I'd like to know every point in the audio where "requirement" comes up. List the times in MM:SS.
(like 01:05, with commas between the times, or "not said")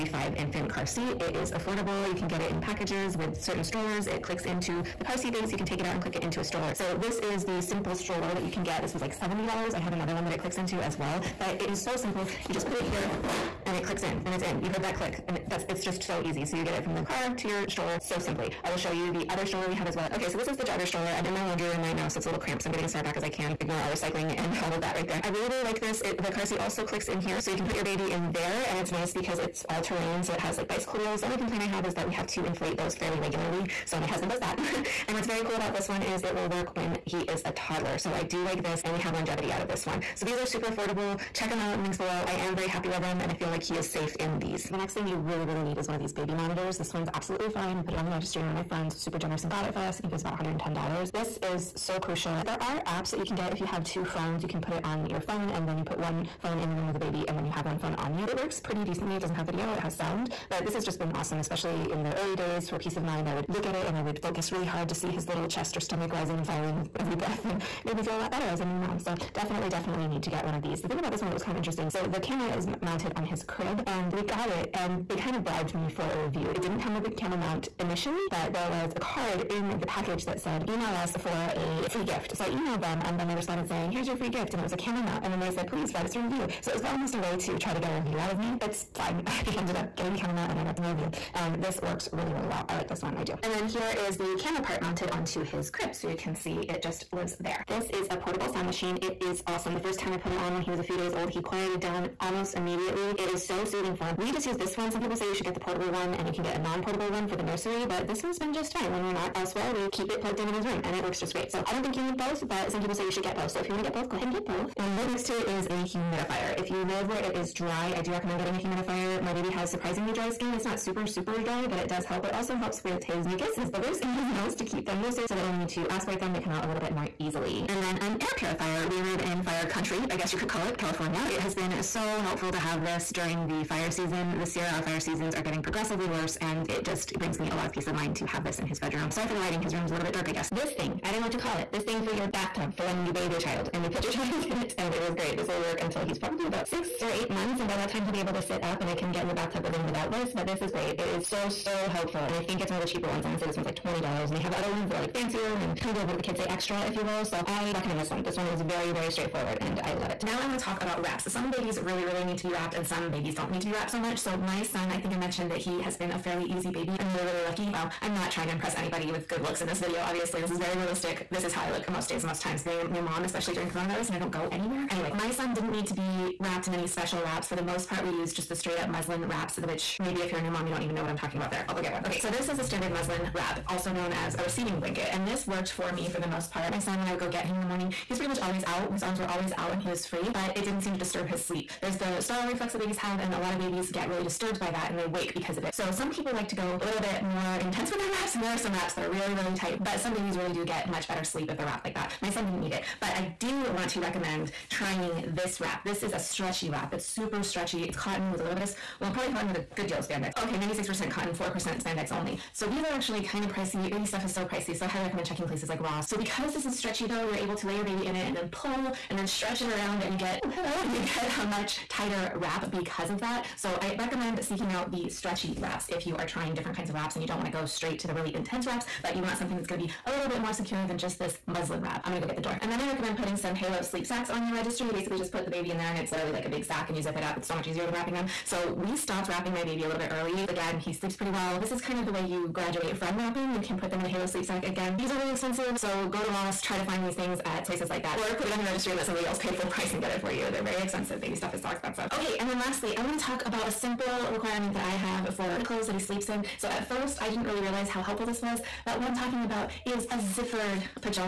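04:14.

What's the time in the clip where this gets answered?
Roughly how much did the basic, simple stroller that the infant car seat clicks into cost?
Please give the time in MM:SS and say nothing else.
00:09.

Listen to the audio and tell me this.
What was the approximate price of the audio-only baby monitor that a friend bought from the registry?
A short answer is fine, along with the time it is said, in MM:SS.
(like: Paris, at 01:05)
$110, at 00:50.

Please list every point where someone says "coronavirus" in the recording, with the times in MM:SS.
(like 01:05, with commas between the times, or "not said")
02:53.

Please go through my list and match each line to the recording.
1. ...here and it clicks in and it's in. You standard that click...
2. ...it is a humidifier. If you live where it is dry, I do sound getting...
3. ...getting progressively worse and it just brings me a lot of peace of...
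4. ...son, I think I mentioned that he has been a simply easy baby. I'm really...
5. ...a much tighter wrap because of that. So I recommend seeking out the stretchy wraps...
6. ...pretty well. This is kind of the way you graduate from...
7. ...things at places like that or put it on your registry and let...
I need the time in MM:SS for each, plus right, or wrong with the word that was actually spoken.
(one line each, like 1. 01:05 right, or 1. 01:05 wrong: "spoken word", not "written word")
1. 00:12 wrong: "heard", not "standard"
2. 01:55 wrong: "recommend", not "sound"
3. 02:15 right
4. 02:44 wrong: "fairly", not "simply"
5. 03:41 right
6. 04:01 right
7. 04:07 right.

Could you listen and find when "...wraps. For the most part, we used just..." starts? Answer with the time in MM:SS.
02:57.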